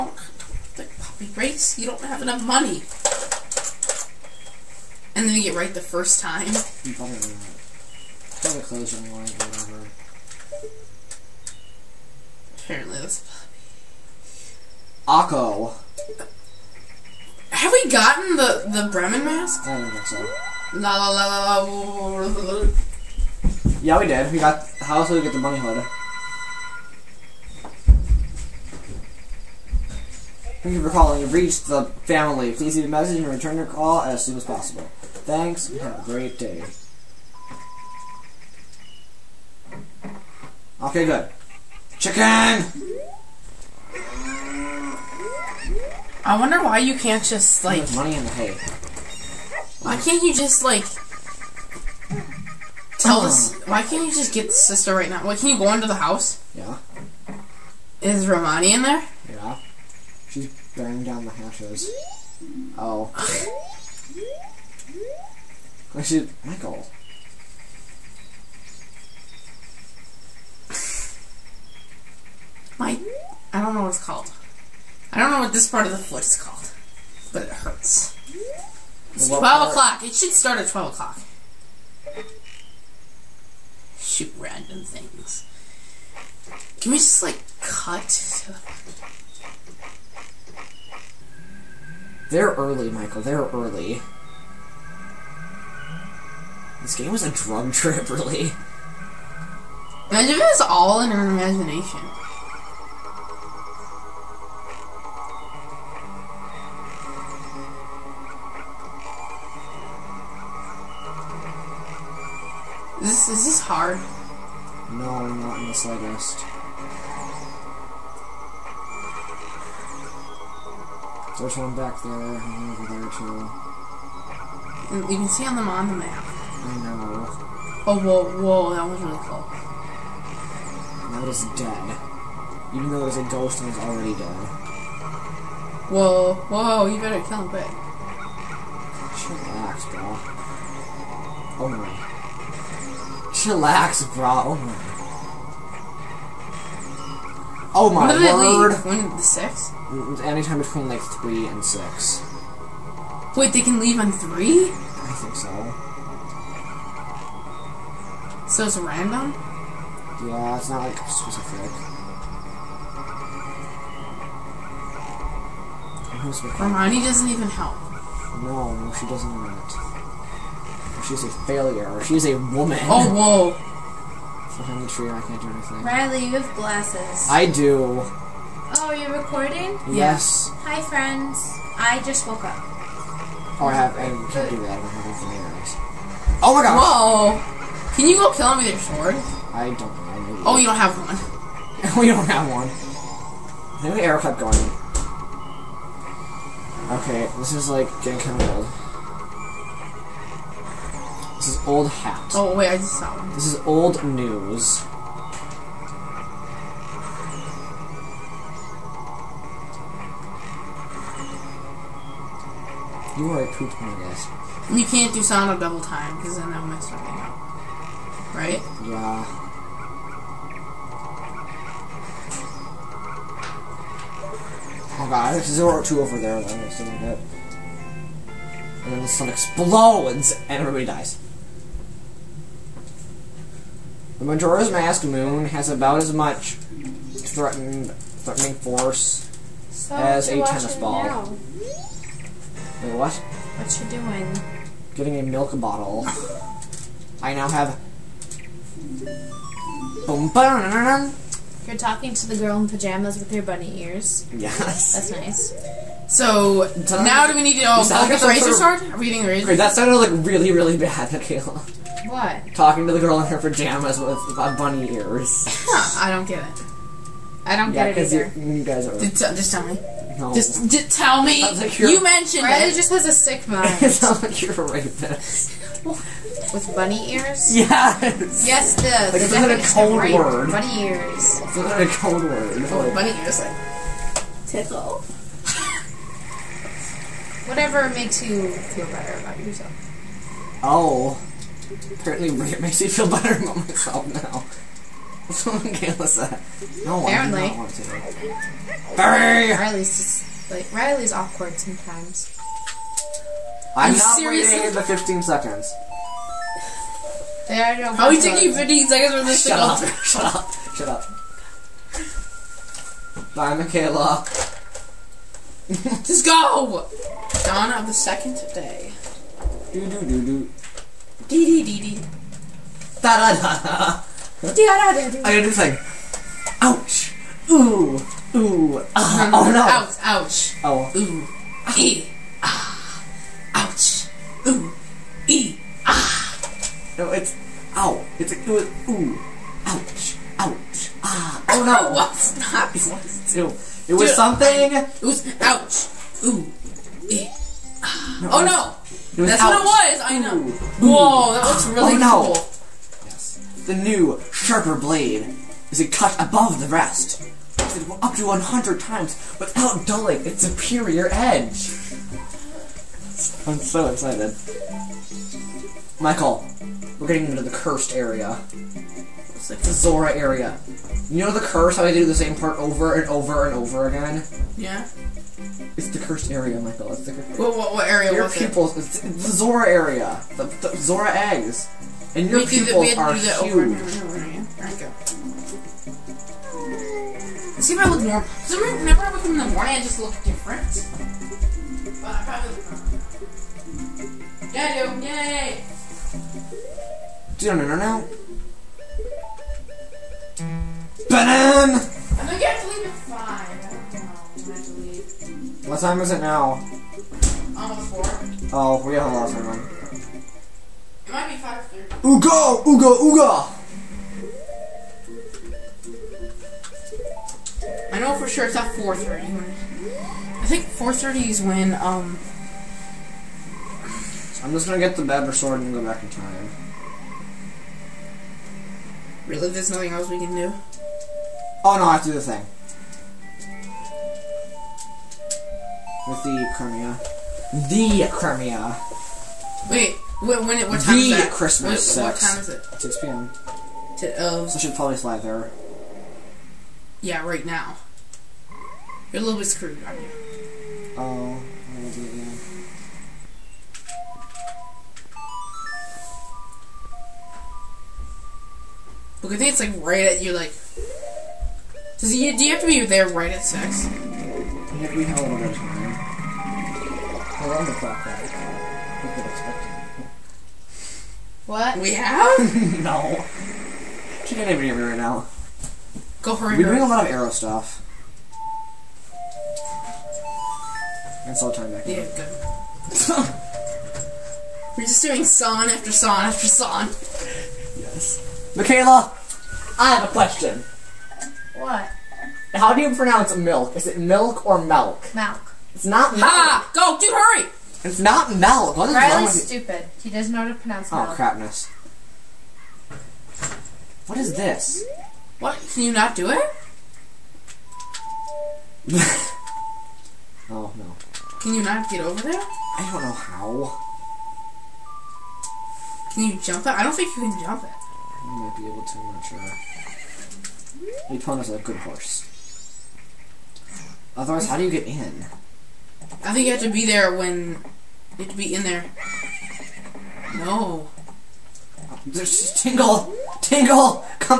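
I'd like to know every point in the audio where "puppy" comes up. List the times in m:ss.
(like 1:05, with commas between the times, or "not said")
0:00, 0:15.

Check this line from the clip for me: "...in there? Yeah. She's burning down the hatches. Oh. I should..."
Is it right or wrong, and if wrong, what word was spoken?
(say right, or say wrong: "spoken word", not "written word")
right.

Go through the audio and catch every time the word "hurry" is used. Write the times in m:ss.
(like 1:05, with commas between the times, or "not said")
8:17.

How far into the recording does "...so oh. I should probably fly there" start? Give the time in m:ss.
7:24.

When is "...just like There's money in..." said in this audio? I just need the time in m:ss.
0:47.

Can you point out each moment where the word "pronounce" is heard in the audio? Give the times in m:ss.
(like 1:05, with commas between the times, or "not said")
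8:12, 8:20.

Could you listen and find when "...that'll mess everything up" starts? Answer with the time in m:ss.
3:36.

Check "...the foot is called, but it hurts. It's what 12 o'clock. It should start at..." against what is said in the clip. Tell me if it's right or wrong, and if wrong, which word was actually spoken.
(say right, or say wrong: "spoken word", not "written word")
right.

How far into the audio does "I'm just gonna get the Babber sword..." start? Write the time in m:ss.
7:04.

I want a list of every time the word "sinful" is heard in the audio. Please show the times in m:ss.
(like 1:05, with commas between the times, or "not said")
not said.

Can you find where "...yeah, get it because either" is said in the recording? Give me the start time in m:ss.
4:27.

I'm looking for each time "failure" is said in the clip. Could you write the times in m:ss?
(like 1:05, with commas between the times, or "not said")
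2:51.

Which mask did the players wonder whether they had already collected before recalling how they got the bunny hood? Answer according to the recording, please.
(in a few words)
Bremen mask.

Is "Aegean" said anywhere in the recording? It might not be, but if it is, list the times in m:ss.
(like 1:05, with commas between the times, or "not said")
not said.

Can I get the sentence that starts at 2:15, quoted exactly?
Whoa, whoa, you better kill him quick.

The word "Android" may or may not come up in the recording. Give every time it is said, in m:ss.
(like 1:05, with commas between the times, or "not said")
not said.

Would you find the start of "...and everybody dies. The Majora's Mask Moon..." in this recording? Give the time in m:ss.
3:50.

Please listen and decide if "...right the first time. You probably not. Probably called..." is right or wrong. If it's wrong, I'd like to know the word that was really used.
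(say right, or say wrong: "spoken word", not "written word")
wrong: "closed", not "called".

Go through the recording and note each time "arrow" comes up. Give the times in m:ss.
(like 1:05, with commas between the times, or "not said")
3:14, 7:57.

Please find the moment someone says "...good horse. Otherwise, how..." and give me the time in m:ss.
8:41.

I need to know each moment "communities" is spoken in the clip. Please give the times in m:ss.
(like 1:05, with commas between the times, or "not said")
not said.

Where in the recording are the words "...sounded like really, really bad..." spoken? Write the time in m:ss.
4:19.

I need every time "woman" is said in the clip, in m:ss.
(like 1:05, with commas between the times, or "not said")
2:52.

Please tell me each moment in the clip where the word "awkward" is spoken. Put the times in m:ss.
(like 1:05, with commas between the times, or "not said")
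5:01.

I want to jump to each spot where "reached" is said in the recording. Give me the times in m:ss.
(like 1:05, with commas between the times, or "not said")
0:31.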